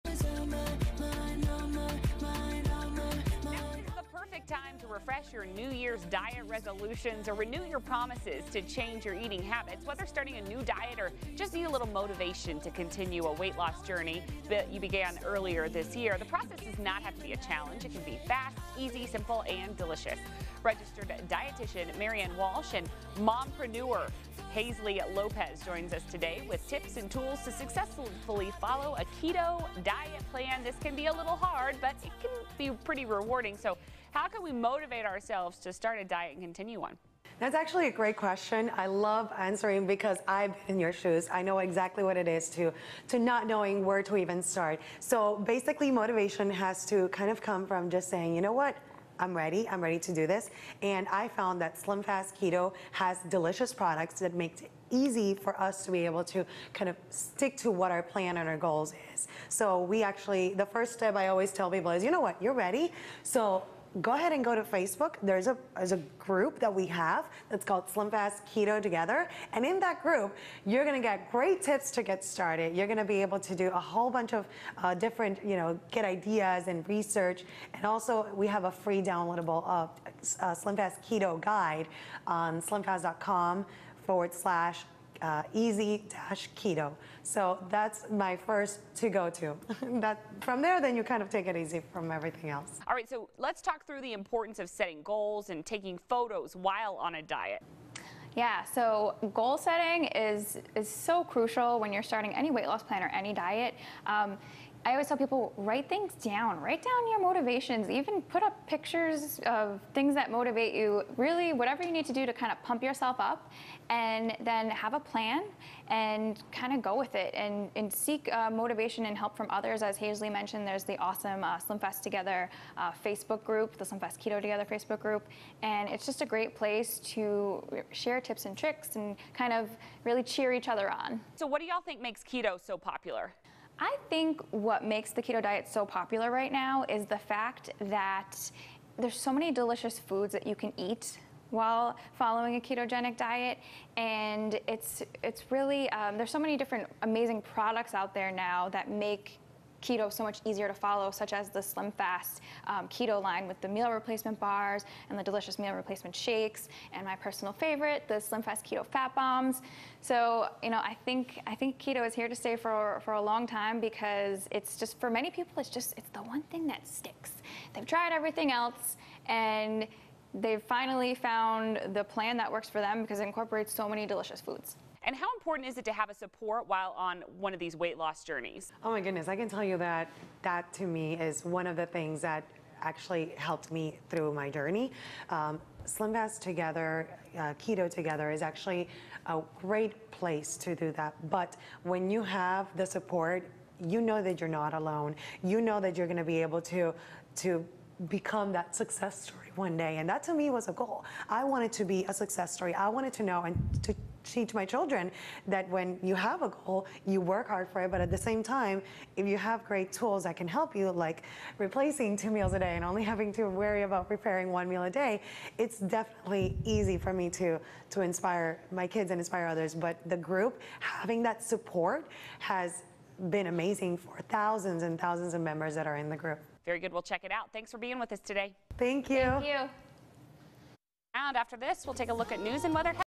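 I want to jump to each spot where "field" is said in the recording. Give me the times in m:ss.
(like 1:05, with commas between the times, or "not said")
not said.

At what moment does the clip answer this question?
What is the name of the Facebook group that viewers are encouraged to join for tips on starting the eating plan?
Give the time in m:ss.
1:07.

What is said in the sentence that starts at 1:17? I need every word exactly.
And also we have a free downloadable uh, uh, Slim Fast Keto Guide on slimfast.com forward slash uh, easy dash keto.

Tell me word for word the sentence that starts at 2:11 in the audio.
So what do y'all think makes keto so popular?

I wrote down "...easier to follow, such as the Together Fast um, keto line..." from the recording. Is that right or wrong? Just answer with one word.
wrong.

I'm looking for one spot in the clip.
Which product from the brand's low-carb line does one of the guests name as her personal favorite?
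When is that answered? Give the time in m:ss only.
2:38.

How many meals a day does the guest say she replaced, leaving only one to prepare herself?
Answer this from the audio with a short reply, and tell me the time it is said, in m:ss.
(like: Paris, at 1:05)
2, at 3:32.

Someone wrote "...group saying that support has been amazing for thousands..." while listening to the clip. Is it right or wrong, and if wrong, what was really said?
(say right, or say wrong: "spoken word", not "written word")
wrong: "having", not "saying".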